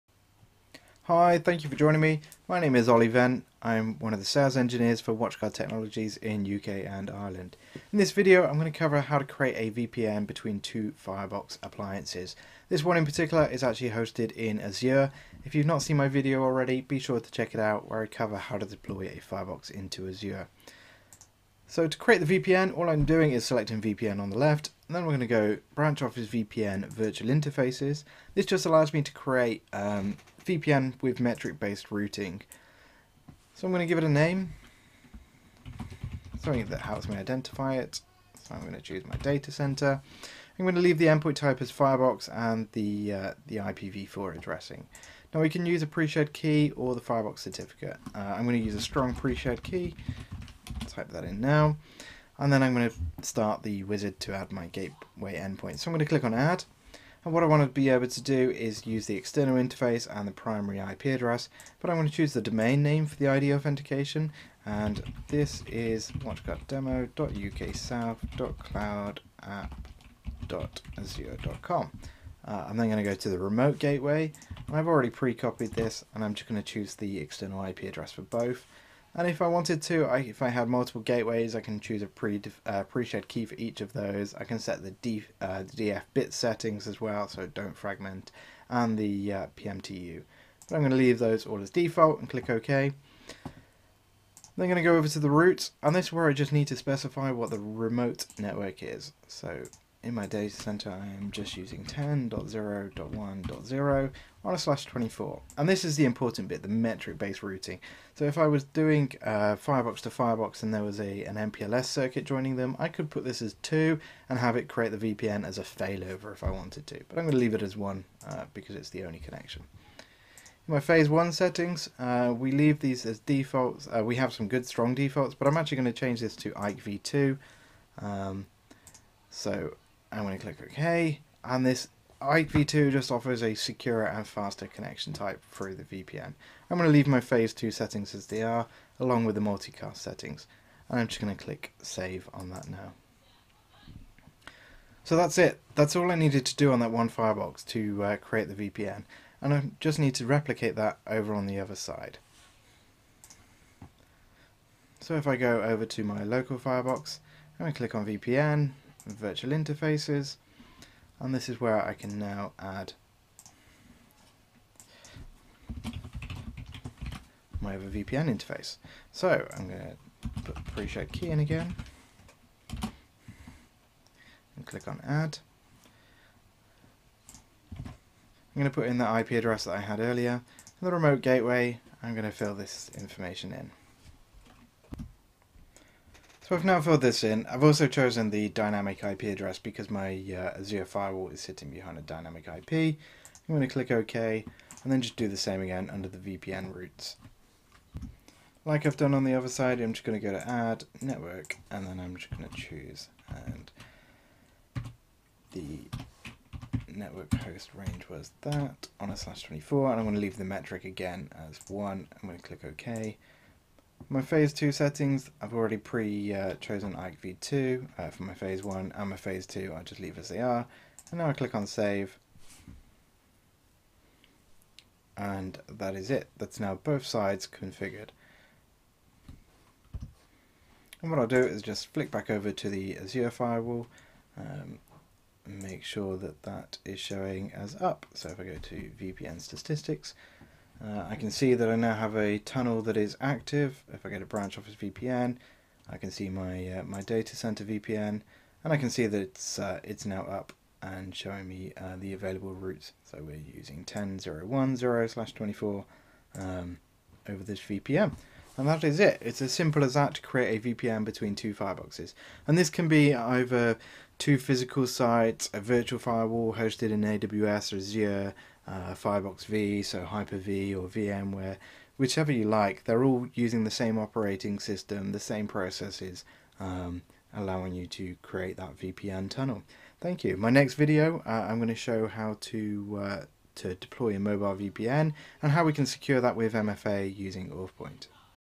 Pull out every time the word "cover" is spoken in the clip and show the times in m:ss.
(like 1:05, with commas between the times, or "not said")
0:08, 0:18.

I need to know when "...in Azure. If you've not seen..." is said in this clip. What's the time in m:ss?
0:14.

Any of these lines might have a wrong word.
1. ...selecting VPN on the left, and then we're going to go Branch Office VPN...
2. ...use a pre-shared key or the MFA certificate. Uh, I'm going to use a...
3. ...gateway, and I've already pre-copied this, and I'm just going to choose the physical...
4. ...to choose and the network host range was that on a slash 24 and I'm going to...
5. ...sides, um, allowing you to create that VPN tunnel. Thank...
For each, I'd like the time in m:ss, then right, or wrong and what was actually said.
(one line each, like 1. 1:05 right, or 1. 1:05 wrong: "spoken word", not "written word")
1. 0:23 right
2. 0:45 wrong: "Firebox", not "MFA"
3. 1:13 wrong: "external", not "physical"
4. 3:22 right
5. 4:35 wrong: "processes", not "sides".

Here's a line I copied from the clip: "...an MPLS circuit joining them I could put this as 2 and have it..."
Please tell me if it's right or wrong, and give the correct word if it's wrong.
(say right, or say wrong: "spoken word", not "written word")
right.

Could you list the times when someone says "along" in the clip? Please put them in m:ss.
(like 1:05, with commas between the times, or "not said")
2:18.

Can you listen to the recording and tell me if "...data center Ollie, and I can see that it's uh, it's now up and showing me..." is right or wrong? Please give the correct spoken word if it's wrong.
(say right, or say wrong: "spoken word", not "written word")
wrong: "VPN", not "Ollie".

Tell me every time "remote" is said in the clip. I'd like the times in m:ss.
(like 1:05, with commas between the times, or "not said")
1:13, 1:37, 3:00.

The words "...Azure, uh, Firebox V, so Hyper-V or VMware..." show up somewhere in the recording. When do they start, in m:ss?
4:27.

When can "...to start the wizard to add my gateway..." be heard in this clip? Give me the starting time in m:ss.
0:52.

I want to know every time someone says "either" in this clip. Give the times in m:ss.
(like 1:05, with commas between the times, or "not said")
4:23.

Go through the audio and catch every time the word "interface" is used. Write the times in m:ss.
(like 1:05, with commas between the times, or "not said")
0:27, 0:59, 2:39, 2:48.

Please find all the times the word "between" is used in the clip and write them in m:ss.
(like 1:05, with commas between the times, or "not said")
0:10, 4:21.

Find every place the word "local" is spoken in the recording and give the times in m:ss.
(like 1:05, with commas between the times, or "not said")
2:36.